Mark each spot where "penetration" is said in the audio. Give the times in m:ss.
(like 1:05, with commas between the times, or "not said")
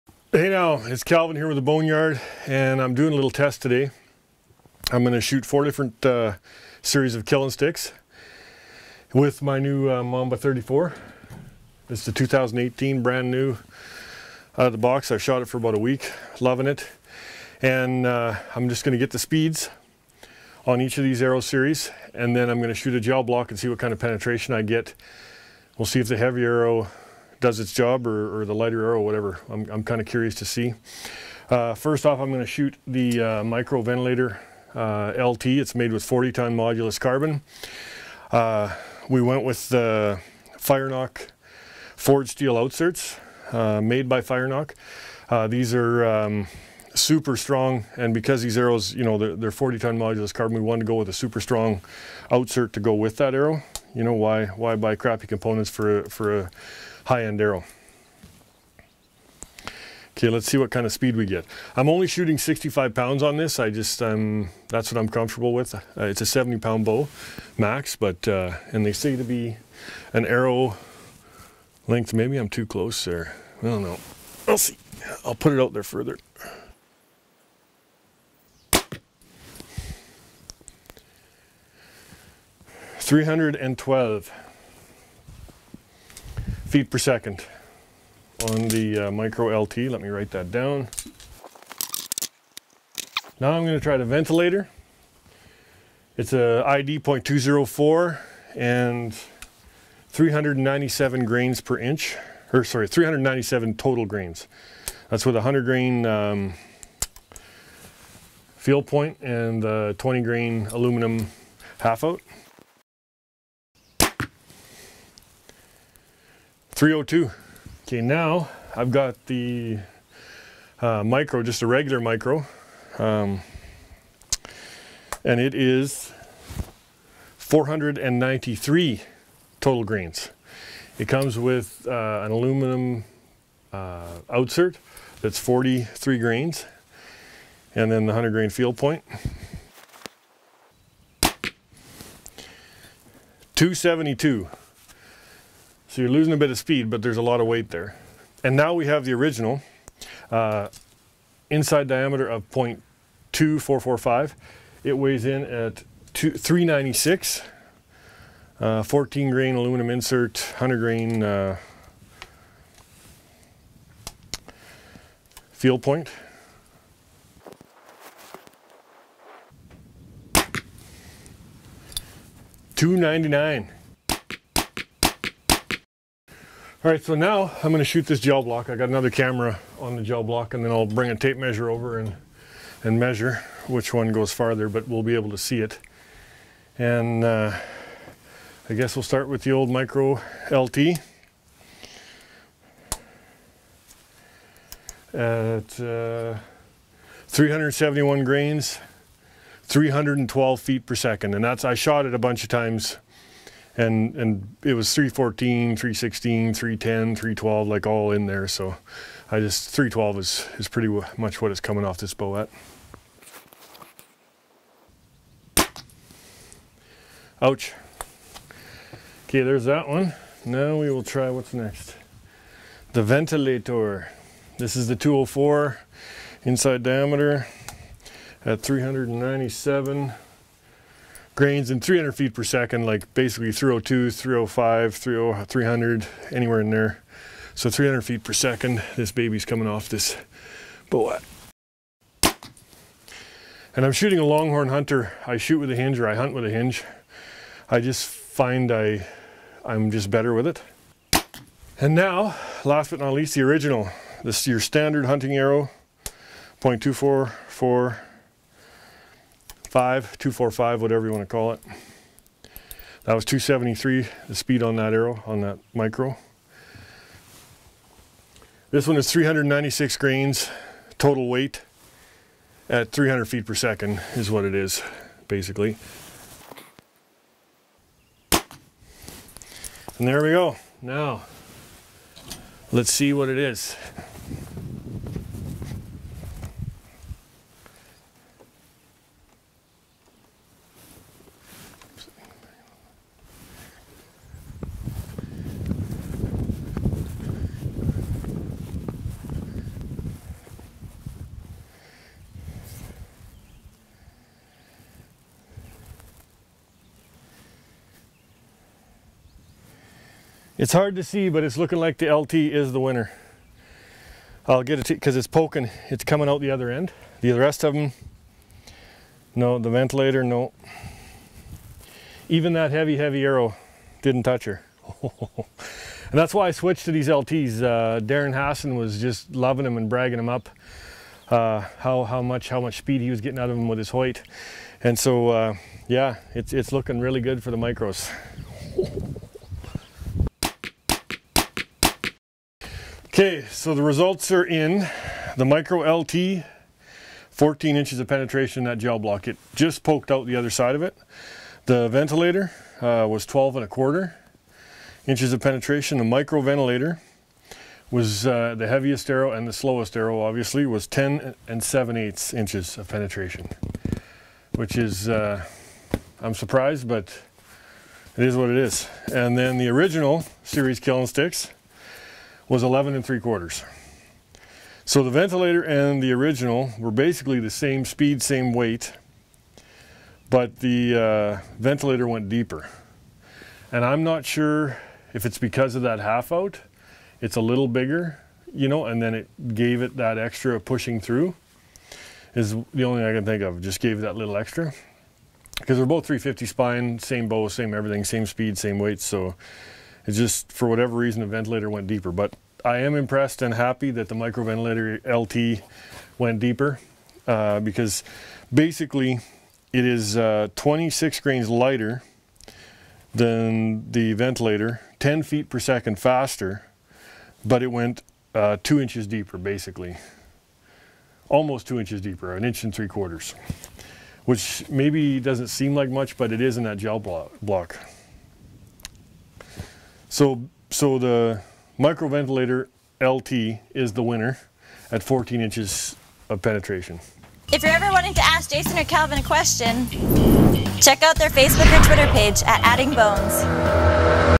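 0:23, 5:48, 5:55, 6:02, 7:16.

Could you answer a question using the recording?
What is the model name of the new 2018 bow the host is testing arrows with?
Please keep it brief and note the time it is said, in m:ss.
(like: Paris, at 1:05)
Mamba 34, at 0:10.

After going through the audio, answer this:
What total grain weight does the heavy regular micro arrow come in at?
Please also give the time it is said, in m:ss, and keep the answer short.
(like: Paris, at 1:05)
493 grains, at 2:07.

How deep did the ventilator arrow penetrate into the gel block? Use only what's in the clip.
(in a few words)
12 1/4 inches.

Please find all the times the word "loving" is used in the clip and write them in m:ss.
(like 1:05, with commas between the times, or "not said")
0:16, 5:29.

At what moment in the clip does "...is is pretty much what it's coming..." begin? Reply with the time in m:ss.
3:30.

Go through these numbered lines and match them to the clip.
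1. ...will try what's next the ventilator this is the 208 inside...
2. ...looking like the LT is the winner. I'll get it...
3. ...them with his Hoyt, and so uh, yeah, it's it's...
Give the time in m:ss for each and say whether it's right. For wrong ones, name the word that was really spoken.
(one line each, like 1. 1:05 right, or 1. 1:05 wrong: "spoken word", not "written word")
1. 3:40 wrong: "204", not "208"
2. 5:11 right
3. 5:33 right.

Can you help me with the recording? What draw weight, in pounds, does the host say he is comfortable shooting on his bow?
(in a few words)
65 pounds.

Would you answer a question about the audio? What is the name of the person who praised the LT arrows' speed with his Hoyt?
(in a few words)
Darren Hassan.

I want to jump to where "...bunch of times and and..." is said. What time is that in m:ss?
3:22.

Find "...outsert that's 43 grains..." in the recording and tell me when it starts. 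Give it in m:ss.
2:14.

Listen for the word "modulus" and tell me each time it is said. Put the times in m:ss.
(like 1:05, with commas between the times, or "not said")
0:36, 0:49.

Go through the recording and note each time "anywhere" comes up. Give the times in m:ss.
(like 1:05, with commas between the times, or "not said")
3:56.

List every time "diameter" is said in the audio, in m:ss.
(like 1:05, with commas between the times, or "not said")
2:31, 3:46.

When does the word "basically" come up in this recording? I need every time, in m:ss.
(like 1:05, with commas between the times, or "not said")
3:53, 4:35, 6:16, 6:48, 6:59.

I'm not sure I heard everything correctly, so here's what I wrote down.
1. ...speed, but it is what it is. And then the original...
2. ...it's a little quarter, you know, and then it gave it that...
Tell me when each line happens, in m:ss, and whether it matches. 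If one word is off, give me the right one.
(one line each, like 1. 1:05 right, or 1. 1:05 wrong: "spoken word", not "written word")
1. 6:06 wrong: "surprised", not "speed"
2. 6:27 wrong: "bigger", not "quarter".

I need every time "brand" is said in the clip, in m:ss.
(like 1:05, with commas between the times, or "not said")
0:13.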